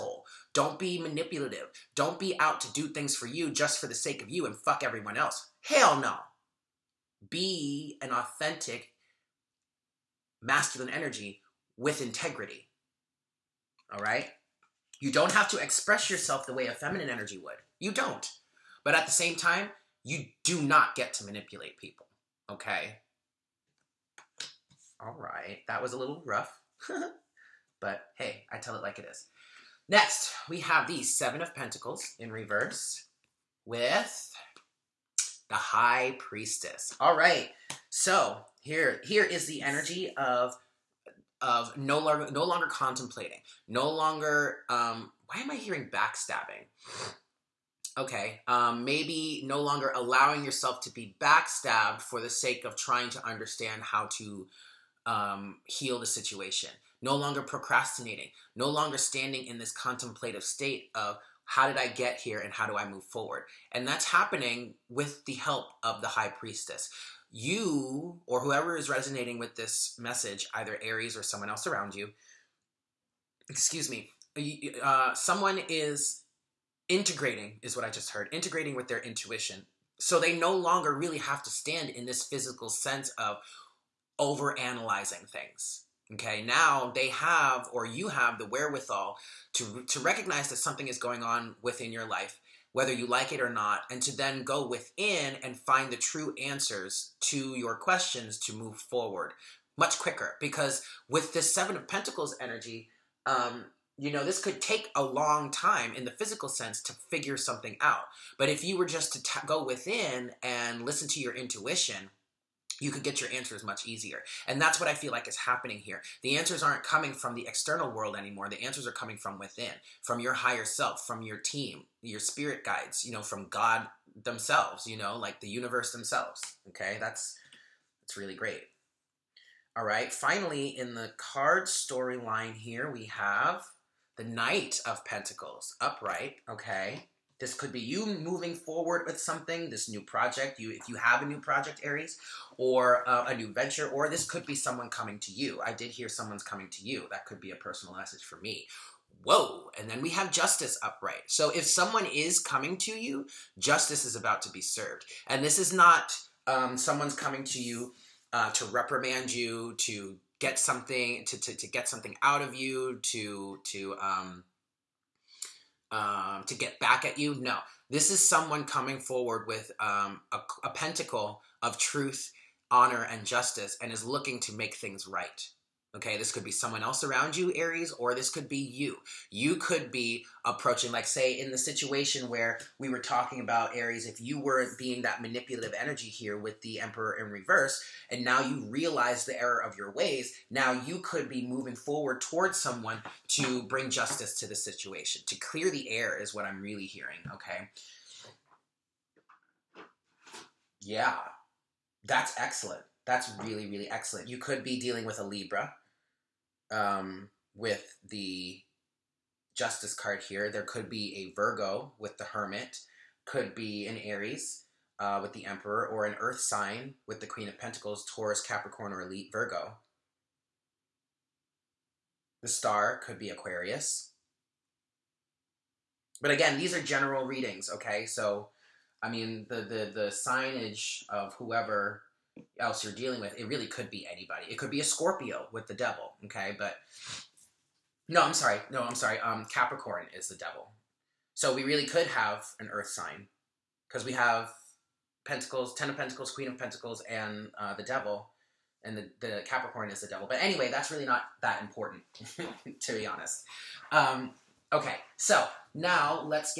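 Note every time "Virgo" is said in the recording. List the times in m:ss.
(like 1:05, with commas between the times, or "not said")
3:31, 3:39.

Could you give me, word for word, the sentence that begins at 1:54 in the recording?
And that's what I feel like is happening here.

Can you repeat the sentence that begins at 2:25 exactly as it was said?
I did hear someone's coming to you.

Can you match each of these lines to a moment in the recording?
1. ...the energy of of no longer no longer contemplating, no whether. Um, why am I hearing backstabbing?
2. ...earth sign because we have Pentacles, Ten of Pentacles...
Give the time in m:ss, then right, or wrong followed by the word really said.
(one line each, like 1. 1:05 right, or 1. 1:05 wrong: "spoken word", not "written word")
1. 0:39 wrong: "longer", not "whether"
2. 4:02 right.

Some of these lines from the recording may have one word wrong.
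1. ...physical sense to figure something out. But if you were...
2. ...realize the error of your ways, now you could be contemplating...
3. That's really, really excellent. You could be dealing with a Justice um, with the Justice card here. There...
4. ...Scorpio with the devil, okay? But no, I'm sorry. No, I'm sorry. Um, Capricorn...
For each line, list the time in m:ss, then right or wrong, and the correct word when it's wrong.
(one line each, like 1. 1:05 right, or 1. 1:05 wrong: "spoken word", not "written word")
1. 1:46 right
2. 3:08 wrong: "moving", not "contemplating"
3. 3:23 wrong: "Libra", not "Justice"
4. 3:54 right.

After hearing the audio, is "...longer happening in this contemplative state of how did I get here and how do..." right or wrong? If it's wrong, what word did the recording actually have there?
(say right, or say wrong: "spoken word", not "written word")
wrong: "standing", not "happening".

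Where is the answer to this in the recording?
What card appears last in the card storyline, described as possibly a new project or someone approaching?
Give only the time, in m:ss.
2:14.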